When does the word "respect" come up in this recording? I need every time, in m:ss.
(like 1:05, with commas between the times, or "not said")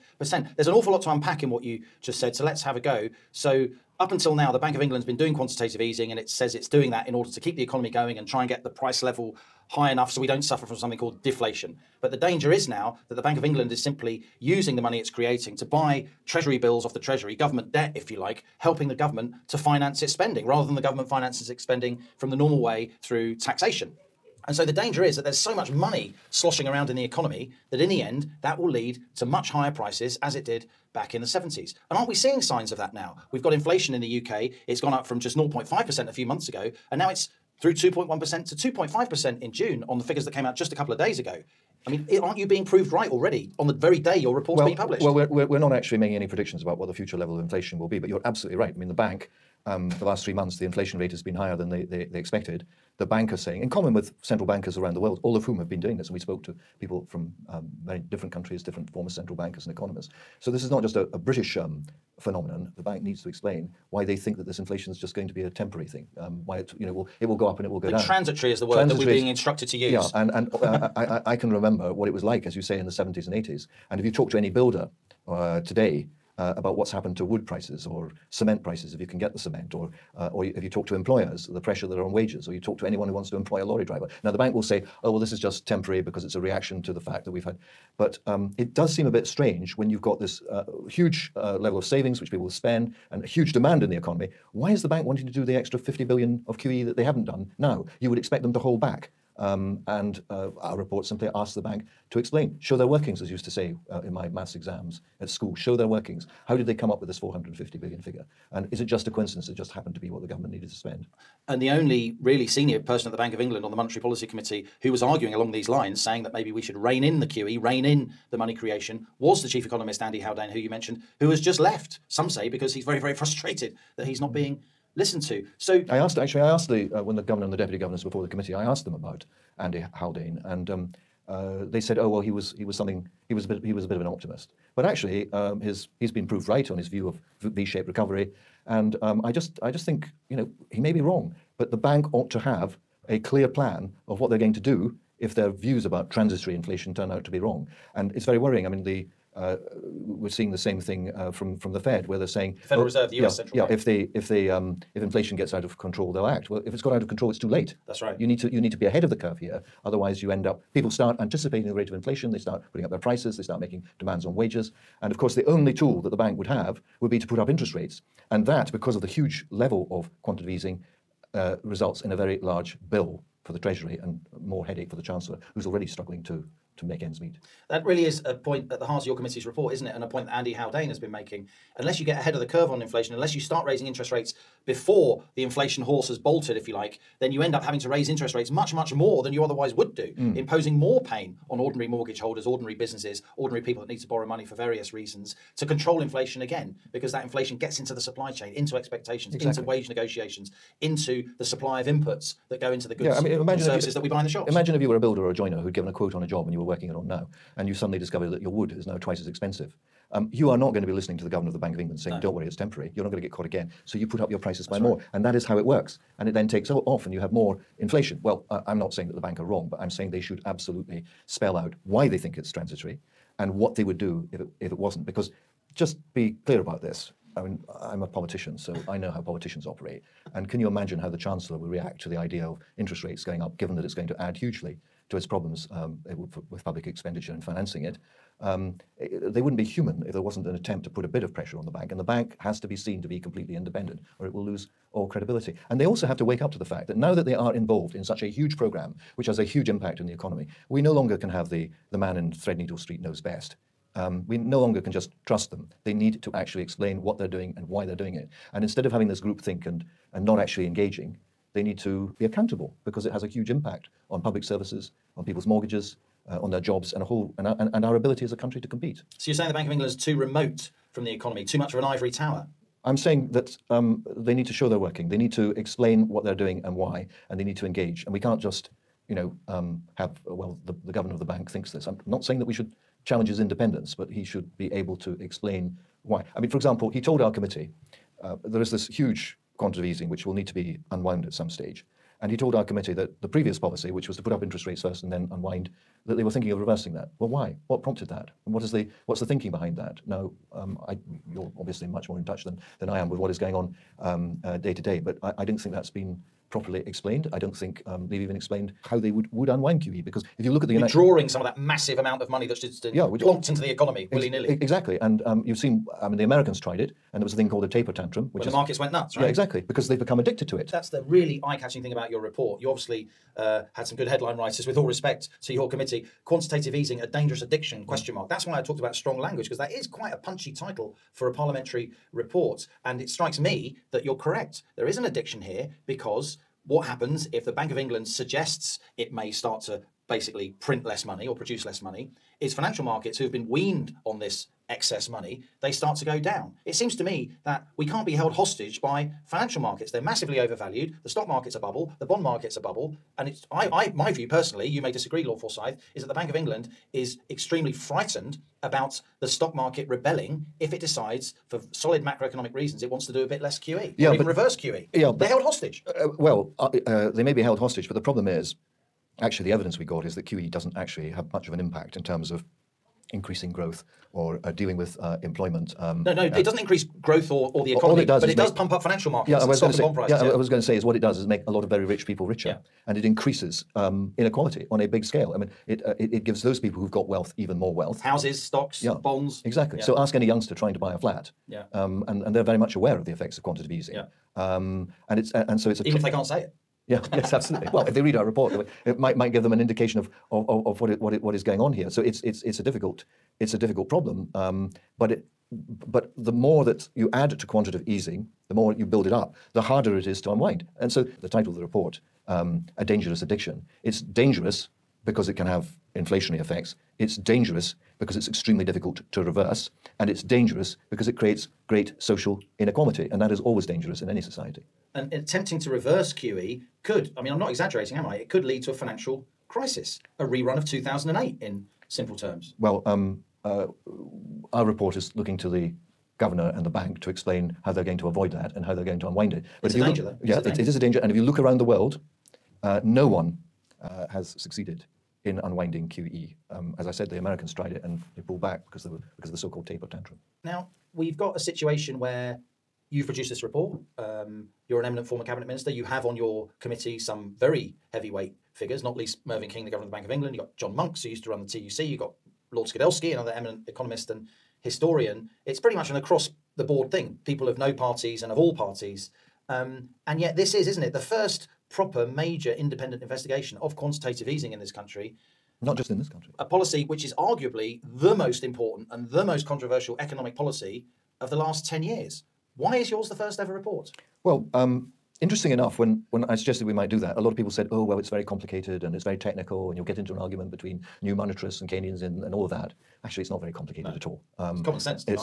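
5:24.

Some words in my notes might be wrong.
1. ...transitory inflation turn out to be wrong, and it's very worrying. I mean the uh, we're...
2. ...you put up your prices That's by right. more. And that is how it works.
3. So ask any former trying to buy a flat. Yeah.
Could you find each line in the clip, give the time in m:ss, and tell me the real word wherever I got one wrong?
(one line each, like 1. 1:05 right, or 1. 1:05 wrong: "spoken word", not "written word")
1. 2:26 right
2. 3:33 right
3. 6:29 wrong: "youngster", not "former".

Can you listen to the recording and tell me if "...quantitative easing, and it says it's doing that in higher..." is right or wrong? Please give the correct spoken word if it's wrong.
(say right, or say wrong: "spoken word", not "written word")
wrong: "order", not "higher".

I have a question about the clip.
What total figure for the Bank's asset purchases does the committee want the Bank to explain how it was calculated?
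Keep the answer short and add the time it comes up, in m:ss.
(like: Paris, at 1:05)
450 billion, at 1:47.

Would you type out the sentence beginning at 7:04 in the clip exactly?
And attempting to reverse QE could, I mean, I'm not exaggerating, am I?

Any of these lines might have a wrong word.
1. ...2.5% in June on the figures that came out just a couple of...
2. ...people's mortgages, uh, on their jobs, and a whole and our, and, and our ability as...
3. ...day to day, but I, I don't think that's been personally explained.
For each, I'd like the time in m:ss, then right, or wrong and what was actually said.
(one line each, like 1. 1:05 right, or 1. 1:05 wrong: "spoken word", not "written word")
1. 0:38 right
2. 4:25 right
3. 5:04 wrong: "properly", not "personally".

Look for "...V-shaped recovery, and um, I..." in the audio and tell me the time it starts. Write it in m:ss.
2:17.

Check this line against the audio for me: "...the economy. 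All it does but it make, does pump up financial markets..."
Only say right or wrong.
right.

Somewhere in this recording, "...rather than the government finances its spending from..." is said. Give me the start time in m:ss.
0:20.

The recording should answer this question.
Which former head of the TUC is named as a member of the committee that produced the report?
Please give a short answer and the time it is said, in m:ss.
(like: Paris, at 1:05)
John Monks, at 7:40.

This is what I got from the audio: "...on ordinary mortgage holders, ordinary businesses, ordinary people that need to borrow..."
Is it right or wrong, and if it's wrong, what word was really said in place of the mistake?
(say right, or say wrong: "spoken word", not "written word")
right.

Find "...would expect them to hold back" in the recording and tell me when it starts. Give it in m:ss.
1:38.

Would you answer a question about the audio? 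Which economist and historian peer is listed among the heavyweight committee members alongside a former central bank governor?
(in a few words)
Lord Skidelsky.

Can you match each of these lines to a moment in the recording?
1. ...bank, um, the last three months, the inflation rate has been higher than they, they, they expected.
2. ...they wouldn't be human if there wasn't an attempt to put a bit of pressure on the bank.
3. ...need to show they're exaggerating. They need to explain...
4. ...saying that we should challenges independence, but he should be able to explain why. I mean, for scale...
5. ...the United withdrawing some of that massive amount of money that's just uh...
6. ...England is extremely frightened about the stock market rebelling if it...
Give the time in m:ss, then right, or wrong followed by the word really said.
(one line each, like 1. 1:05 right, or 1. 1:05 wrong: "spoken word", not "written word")
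1. 0:48 right
2. 3:59 right
3. 4:34 wrong: "working", not "exaggerating"
4. 4:42 wrong: "example", not "scale"
5. 5:10 right
6. 5:56 right.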